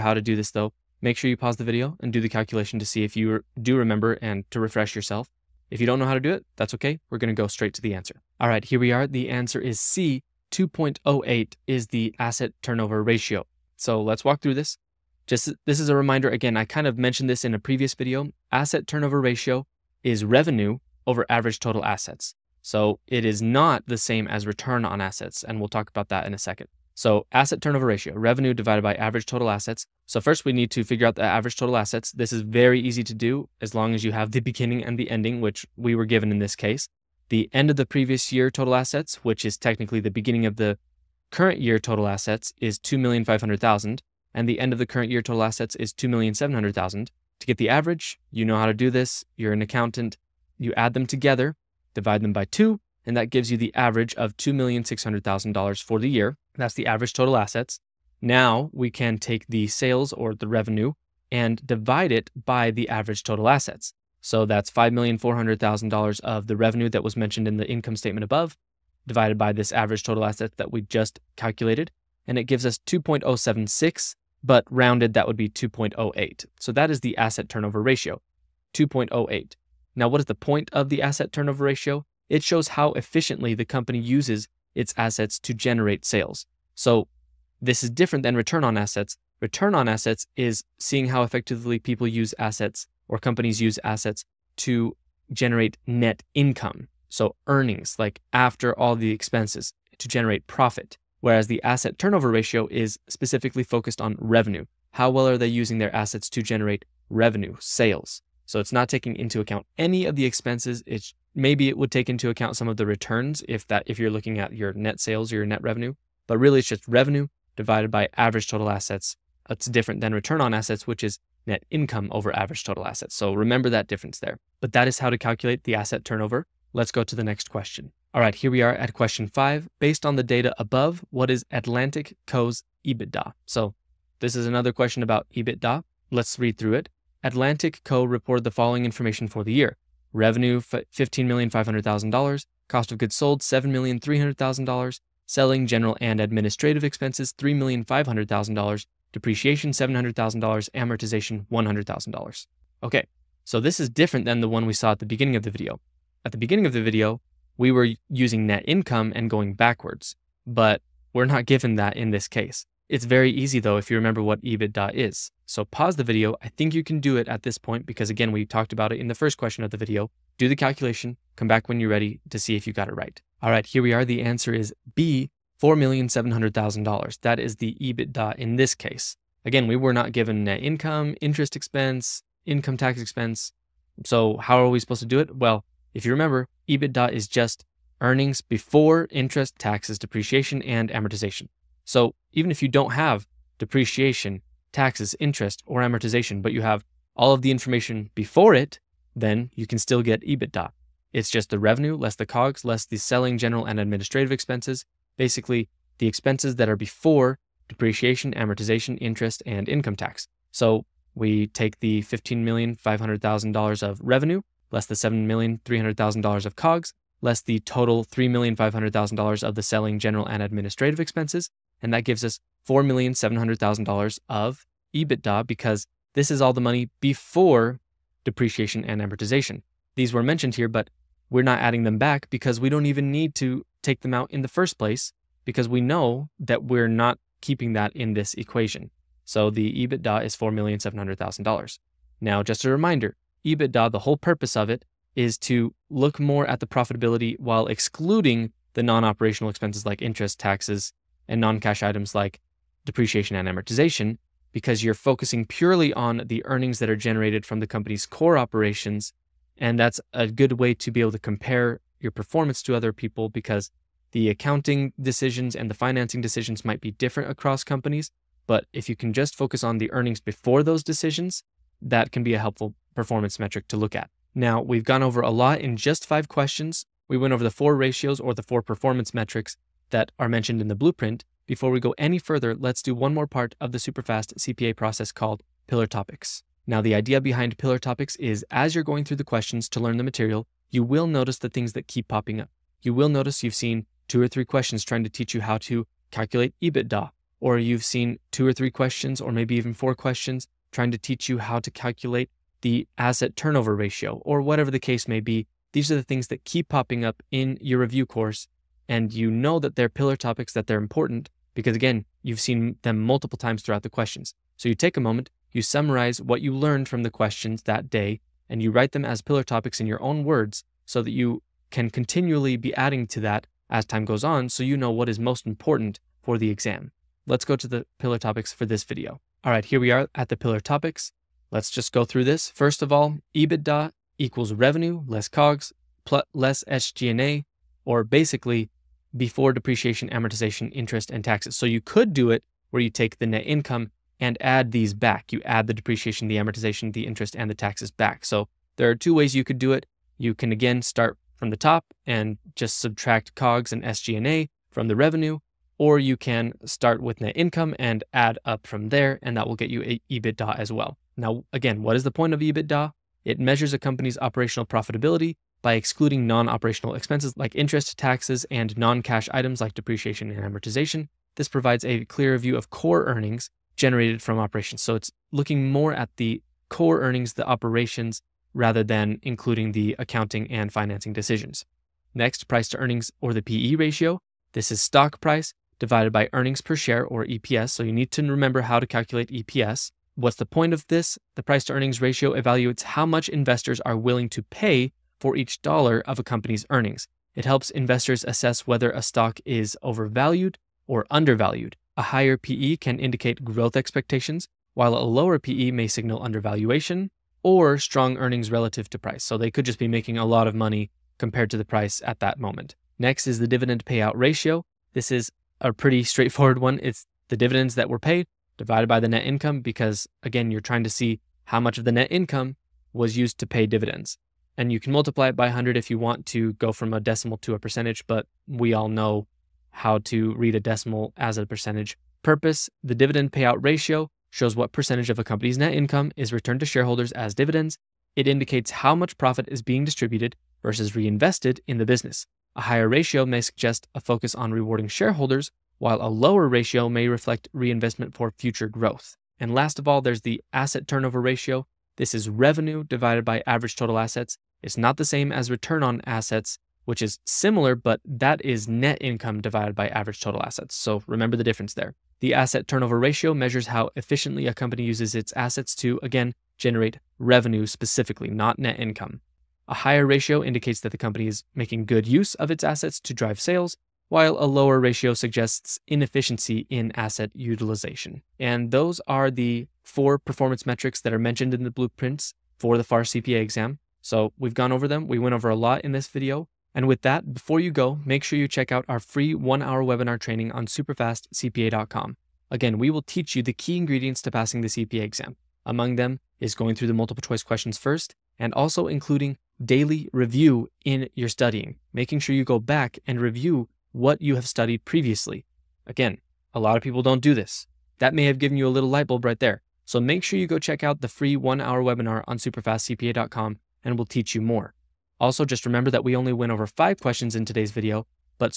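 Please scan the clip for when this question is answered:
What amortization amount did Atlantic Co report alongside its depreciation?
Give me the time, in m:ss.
2:31.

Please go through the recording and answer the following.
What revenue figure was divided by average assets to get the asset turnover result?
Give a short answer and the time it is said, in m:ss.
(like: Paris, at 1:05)
$5,400,000, at 1:04.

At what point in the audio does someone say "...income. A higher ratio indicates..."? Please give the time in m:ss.
7:48.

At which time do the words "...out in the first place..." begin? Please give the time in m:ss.
3:54.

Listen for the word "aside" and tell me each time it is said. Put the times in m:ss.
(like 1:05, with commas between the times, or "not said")
not said.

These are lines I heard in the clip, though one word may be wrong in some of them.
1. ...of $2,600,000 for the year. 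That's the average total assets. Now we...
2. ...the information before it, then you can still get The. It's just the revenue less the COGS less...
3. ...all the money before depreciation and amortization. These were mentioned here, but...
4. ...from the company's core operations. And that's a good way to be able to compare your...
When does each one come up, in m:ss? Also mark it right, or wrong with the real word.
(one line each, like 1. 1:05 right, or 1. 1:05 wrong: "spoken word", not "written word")
1. 0:54 right
2. 3:17 wrong: "EBITDA", not "The"
3. 3:46 right
4. 4:17 right.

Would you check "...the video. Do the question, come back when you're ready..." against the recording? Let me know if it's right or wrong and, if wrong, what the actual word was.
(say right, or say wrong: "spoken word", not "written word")
wrong: "calculation", not "question".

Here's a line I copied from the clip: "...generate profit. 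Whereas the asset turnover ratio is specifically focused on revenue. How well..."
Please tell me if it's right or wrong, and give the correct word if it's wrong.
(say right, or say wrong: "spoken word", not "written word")
right.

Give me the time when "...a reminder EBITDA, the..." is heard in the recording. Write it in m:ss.
4:02.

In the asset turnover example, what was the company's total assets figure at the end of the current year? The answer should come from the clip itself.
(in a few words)
$2,700,000.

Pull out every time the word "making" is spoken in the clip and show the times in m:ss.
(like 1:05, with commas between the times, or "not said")
6:49, 7:51, 8:21.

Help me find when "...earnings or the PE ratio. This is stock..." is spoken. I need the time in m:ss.
6:22.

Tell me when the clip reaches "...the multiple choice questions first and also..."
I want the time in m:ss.
8:16.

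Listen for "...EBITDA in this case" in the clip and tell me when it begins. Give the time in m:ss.
2:57.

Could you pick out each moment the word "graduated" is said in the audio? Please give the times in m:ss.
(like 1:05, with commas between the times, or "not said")
not said.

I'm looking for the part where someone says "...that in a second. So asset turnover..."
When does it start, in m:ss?
0:26.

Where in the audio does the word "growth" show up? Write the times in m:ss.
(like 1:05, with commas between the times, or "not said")
6:43, 7:28.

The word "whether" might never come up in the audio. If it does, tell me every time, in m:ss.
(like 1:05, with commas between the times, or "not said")
6:38.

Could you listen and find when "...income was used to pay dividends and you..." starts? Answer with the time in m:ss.
7:02.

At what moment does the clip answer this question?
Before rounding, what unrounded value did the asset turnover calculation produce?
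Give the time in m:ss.
1:12.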